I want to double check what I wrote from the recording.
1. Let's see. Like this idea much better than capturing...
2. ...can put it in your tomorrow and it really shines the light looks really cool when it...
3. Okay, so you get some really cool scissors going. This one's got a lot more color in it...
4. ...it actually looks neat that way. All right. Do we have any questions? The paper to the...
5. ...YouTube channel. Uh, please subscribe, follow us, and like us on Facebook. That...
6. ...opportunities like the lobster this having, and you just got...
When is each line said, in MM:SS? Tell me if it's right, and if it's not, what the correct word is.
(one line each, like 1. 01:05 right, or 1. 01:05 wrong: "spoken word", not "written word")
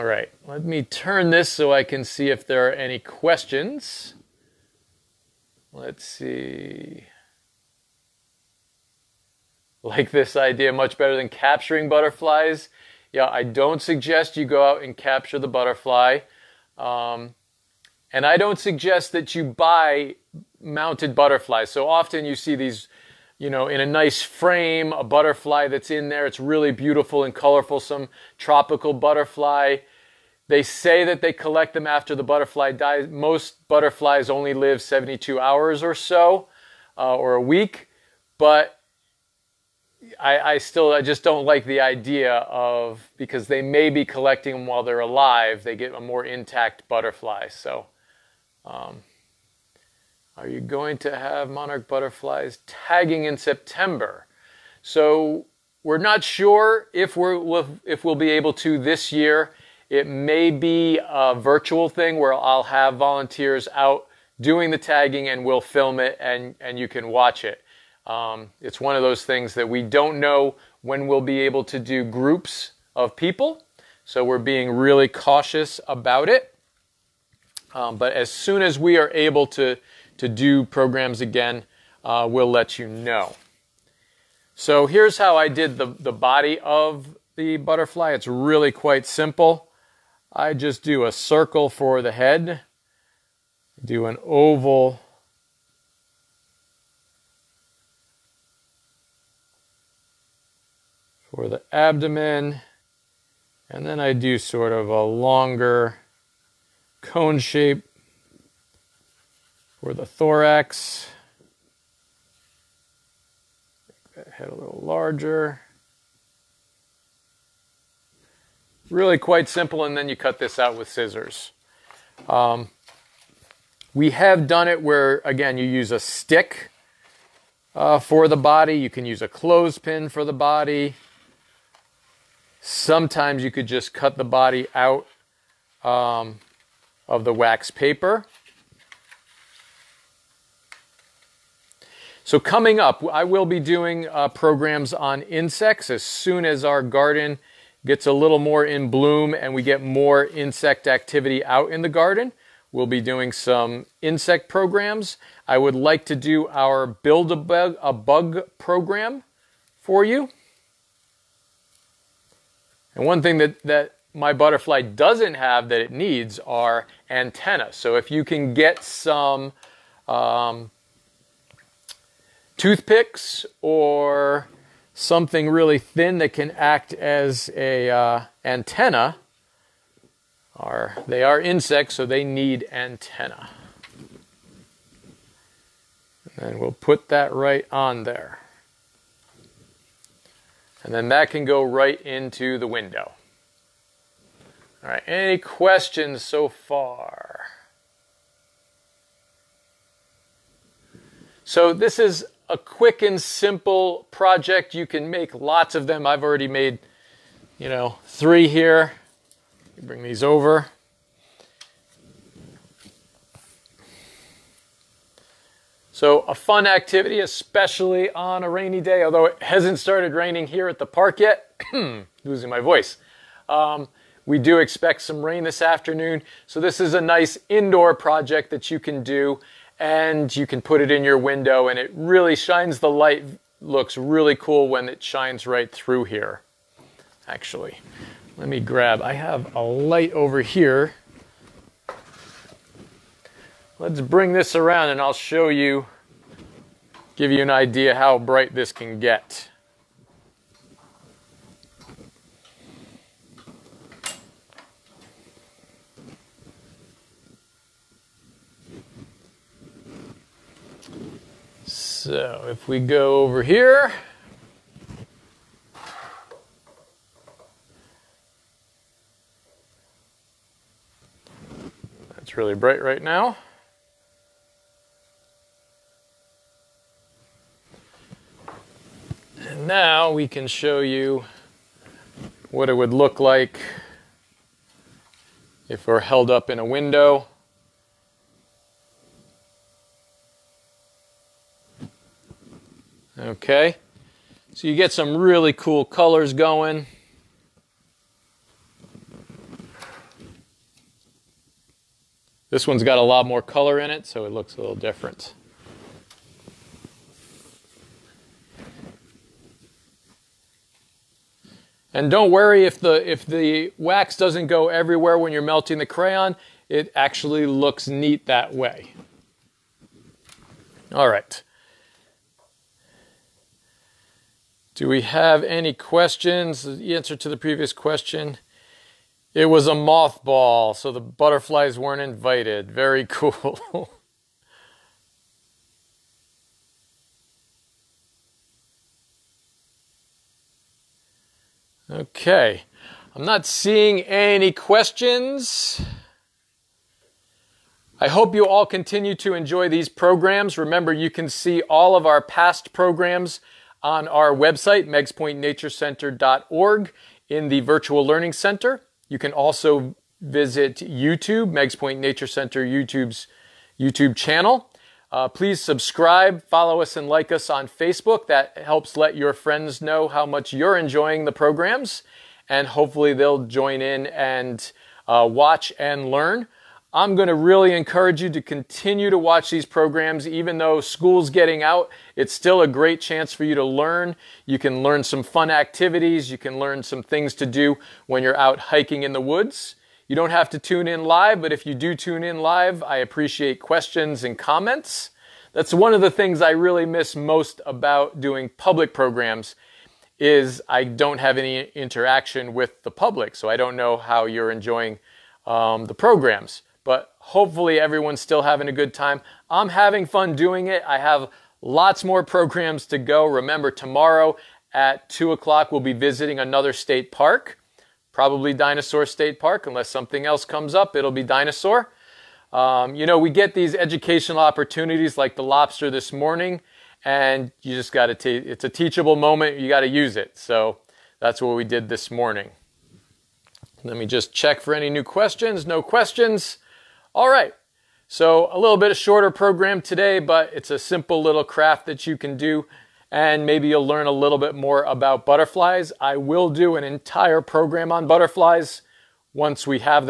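1. 00:05 right
2. 03:50 wrong: "window", not "tomorrow"
3. 04:53 wrong: "colors", not "scissors"
4. 05:16 wrong: "answer", not "paper"
5. 06:03 right
6. 07:04 wrong: "morning", not "having".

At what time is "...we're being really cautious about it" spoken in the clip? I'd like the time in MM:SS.
01:14.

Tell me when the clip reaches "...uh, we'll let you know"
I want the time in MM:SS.
01:22.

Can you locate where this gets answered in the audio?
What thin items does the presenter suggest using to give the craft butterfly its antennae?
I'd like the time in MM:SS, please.
02:52.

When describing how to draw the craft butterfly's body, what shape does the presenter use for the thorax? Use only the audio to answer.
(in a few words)
a longer cone shape.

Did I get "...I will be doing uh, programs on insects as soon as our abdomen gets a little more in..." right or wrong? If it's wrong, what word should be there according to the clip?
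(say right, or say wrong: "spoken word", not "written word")
wrong: "garden", not "abdomen".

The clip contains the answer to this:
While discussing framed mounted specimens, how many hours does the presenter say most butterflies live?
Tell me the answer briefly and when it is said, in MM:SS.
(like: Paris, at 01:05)
72 hours, at 00:34.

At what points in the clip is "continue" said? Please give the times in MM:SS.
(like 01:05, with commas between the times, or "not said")
05:48, 06:18.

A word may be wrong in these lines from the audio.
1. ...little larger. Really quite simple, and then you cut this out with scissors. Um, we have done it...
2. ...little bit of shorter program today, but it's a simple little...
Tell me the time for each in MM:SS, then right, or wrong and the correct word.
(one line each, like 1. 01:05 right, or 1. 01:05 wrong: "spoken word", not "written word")
1. 01:54 right
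2. 07:18 right.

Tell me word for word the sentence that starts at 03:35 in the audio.
So a fun activity, especially on a rainy day, although it hasn't started raining here at the park yet.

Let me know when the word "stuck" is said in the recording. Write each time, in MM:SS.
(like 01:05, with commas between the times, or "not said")
not said.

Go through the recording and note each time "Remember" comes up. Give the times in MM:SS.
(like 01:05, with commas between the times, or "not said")
05:50, 06:53.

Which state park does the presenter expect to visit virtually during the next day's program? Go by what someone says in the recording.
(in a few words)
Dinosaur State Park.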